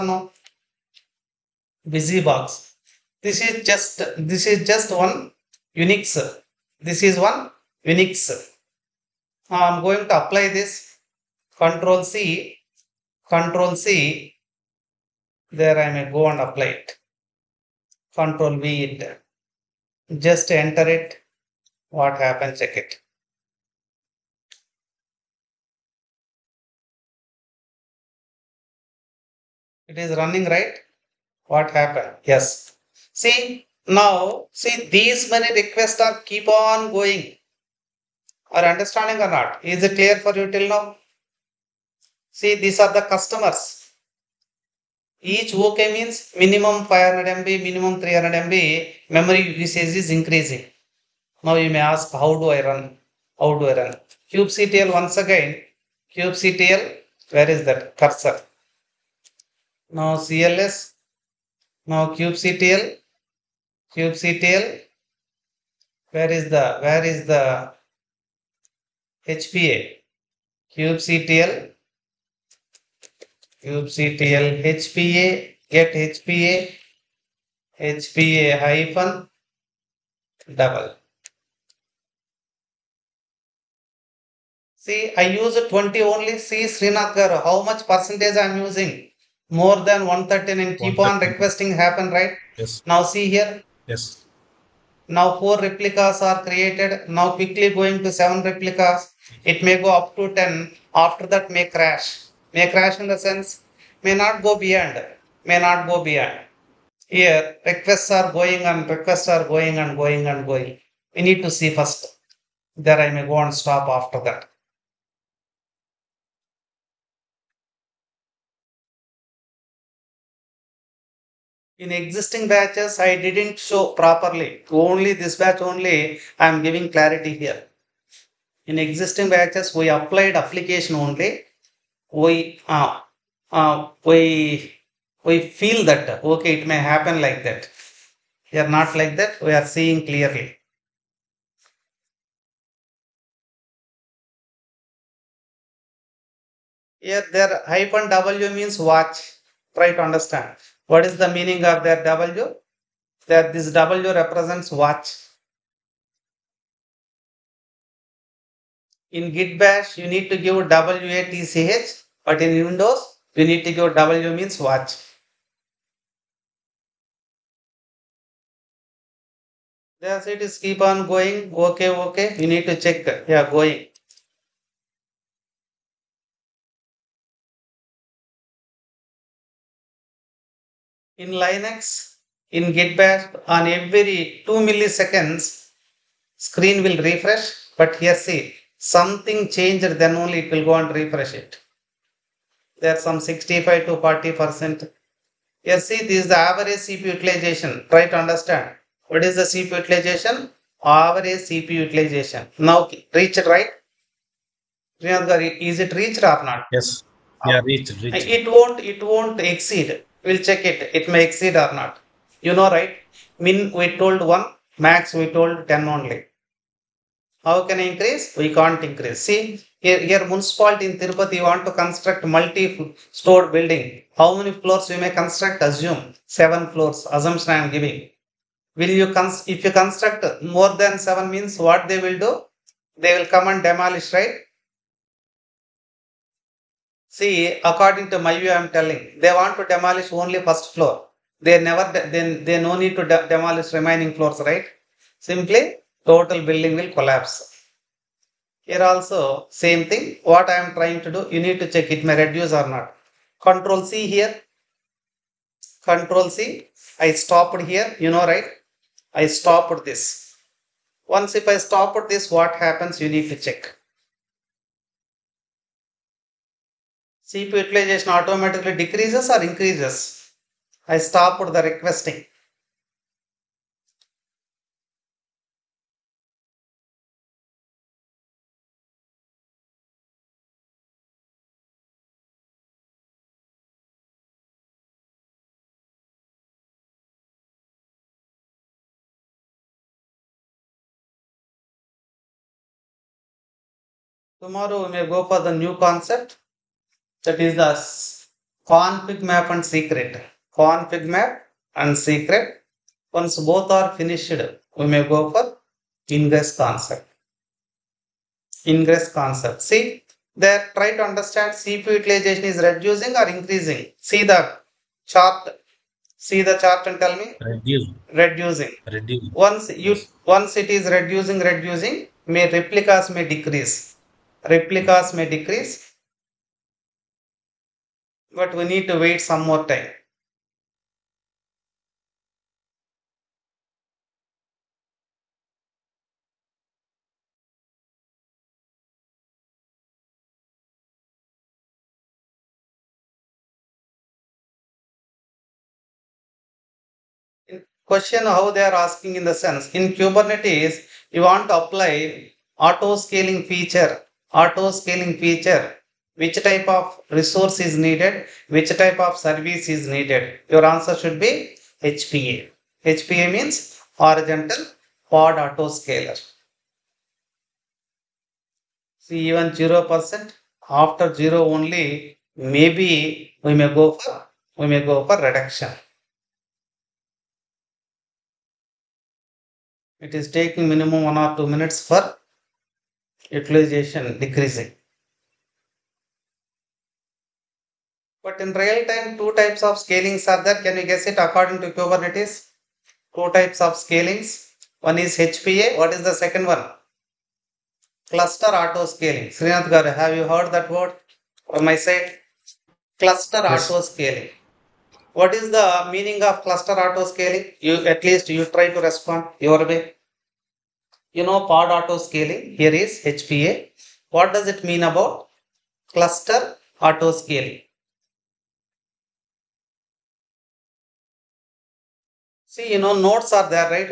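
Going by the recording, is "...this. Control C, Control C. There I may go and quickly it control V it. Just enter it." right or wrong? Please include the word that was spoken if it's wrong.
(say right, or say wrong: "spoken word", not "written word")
wrong: "apply", not "quickly".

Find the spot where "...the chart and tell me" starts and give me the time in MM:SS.
05:16.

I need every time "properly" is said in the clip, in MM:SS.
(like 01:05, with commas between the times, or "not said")
02:03.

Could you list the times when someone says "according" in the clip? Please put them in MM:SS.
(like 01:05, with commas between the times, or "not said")
03:57, 06:31.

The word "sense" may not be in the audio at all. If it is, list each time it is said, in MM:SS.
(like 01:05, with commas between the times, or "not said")
01:43, 05:49.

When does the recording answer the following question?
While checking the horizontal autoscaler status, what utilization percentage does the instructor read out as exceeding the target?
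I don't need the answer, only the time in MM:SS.
01:30.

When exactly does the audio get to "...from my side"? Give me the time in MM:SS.
06:41.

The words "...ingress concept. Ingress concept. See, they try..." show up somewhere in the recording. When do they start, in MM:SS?
05:06.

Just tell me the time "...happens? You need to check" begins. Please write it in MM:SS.
04:22.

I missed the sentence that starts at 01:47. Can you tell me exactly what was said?
Here, requests are going and requests are going and going and going.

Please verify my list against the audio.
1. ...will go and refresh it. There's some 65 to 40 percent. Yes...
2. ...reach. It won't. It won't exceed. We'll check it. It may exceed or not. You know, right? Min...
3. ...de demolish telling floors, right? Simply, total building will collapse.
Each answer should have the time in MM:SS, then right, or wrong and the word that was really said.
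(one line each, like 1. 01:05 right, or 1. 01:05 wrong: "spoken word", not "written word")
1. 03:10 right
2. 03:28 right
3. 04:03 wrong: "remaining", not "telling".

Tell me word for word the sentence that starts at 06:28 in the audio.
But in real time, two types of scalings are there.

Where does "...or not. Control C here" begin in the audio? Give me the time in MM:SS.
04:12.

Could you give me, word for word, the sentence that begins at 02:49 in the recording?
That's it is keep on going.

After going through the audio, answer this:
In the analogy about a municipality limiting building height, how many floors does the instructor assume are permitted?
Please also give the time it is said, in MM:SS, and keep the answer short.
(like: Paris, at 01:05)
7, at 03:46.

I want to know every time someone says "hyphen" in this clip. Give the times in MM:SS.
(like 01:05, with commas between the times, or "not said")
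01:18, 02:27.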